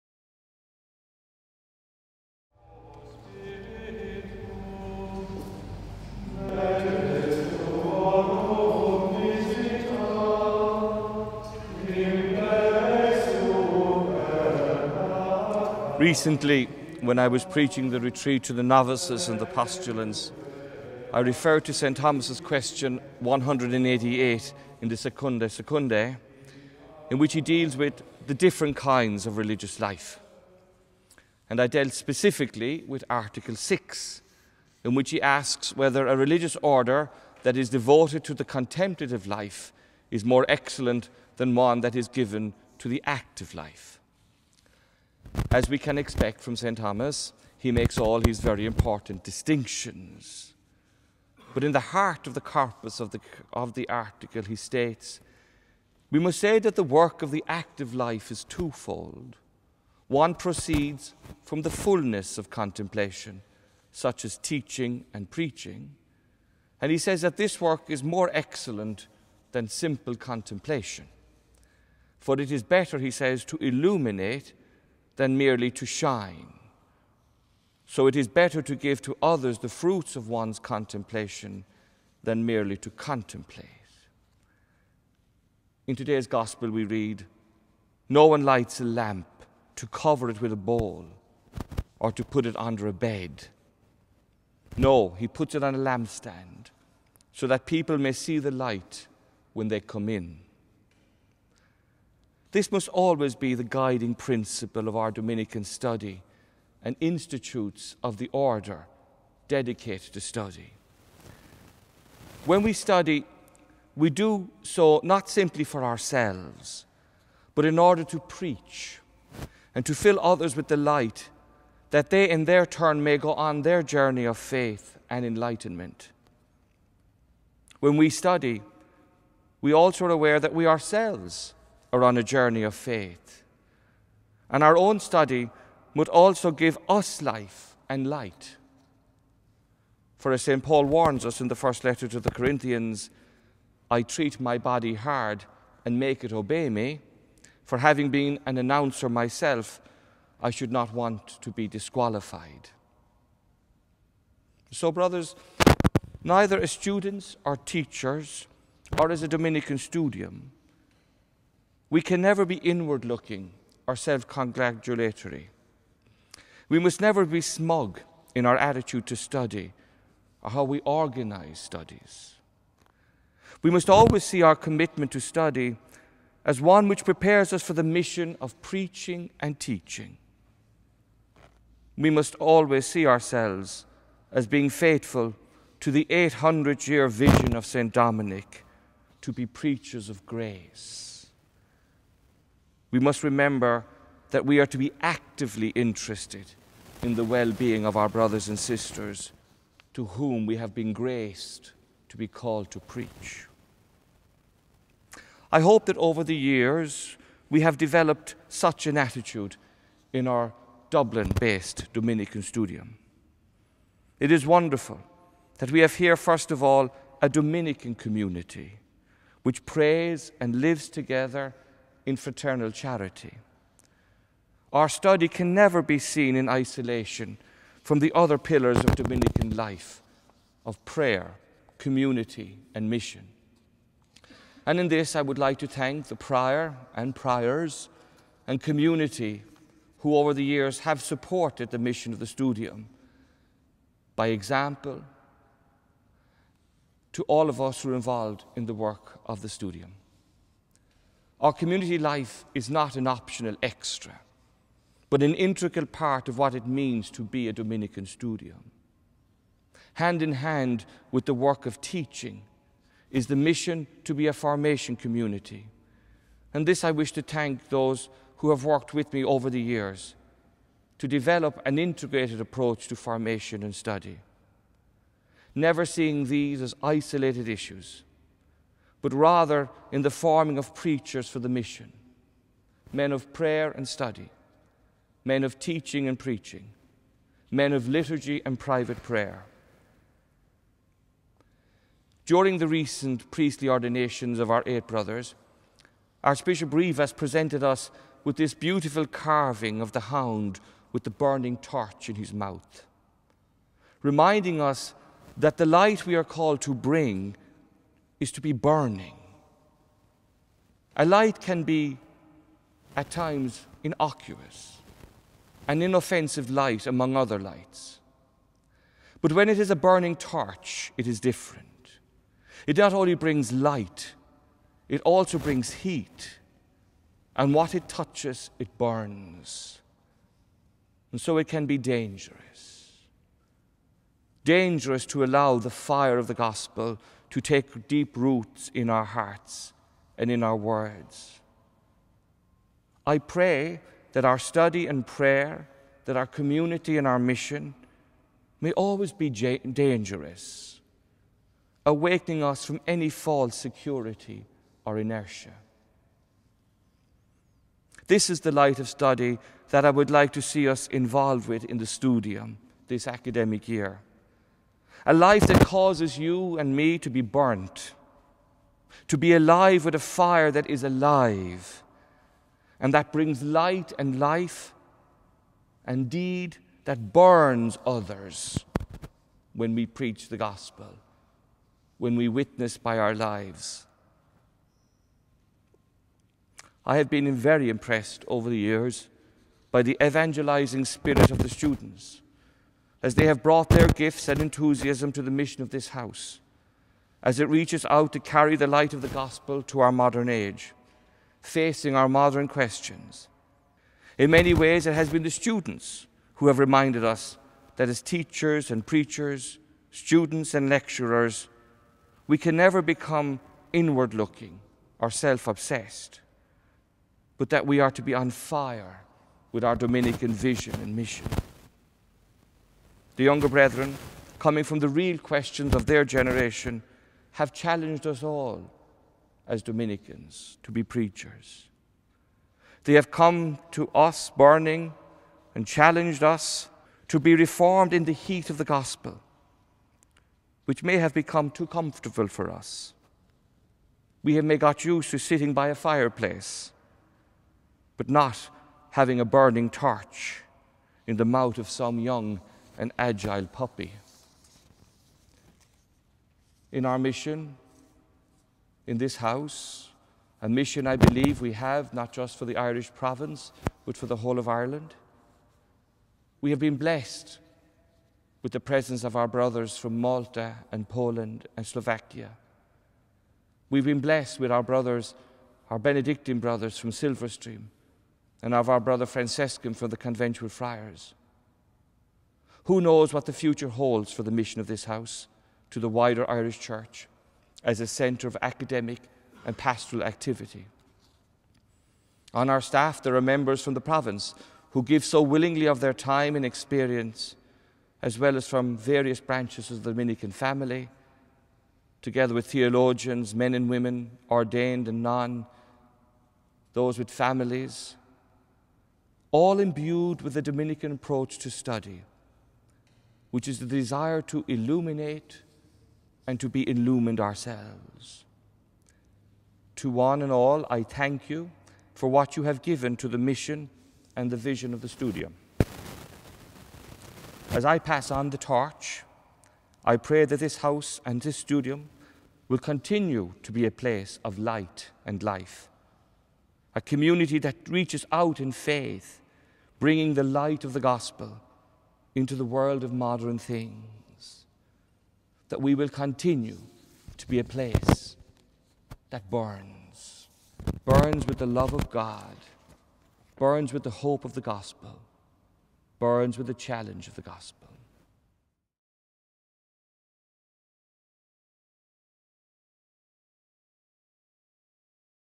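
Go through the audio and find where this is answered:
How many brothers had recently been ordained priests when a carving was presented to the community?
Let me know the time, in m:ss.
4:54.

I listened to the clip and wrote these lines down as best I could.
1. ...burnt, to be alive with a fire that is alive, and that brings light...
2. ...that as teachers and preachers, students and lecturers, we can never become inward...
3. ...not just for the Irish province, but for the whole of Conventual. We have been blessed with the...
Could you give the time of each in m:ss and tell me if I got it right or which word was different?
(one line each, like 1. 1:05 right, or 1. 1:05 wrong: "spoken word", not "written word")
1. 6:07 right
2. 6:47 right
3. 7:41 wrong: "Ireland", not "Conventual".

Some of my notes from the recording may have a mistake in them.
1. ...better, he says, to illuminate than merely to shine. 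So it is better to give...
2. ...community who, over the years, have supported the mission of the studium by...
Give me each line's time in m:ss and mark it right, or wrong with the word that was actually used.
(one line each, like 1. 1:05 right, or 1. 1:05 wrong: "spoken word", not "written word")
1. 1:12 right
2. 3:58 right.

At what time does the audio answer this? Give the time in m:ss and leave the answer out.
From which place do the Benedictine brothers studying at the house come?
7:56.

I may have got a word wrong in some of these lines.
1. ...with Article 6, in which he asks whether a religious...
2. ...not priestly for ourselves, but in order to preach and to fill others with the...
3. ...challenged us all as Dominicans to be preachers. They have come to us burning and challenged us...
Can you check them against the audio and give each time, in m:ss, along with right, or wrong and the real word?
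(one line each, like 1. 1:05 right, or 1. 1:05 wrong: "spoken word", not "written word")
1. 0:32 right
2. 1:55 wrong: "simply", not "priestly"
3. 7:07 right.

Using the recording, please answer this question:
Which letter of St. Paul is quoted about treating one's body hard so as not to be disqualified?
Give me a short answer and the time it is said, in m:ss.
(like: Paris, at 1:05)
First letter to the Corinthians, at 2:21.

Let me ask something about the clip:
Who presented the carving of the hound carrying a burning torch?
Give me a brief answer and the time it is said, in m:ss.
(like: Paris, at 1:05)
Archbishop Rivas, at 4:56.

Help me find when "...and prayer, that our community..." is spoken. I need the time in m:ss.
5:44.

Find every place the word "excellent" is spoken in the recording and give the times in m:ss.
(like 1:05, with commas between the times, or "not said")
0:40, 1:08.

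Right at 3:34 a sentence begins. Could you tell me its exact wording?
It is wonderful that we have here, first of all, a Dominican community which prays and lives together in fraternal charity.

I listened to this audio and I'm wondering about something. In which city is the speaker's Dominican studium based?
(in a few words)
Dublin.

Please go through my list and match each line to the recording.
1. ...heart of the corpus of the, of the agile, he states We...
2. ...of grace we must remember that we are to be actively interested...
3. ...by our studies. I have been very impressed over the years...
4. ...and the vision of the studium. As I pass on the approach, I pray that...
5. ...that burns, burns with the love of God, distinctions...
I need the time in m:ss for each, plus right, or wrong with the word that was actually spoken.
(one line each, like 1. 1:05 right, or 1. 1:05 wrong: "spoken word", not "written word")
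1. 0:51 wrong: "article", not "agile"
2. 3:10 right
3. 6:22 wrong: "lives", not "studies"
4. 8:44 wrong: "torch", not "approach"
5. 9:09 wrong: "burns", not "distinctions".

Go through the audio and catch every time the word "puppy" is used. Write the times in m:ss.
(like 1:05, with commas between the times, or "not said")
7:33.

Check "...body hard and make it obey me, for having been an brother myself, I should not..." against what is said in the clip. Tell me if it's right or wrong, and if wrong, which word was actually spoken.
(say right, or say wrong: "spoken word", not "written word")
wrong: "announcer", not "brother".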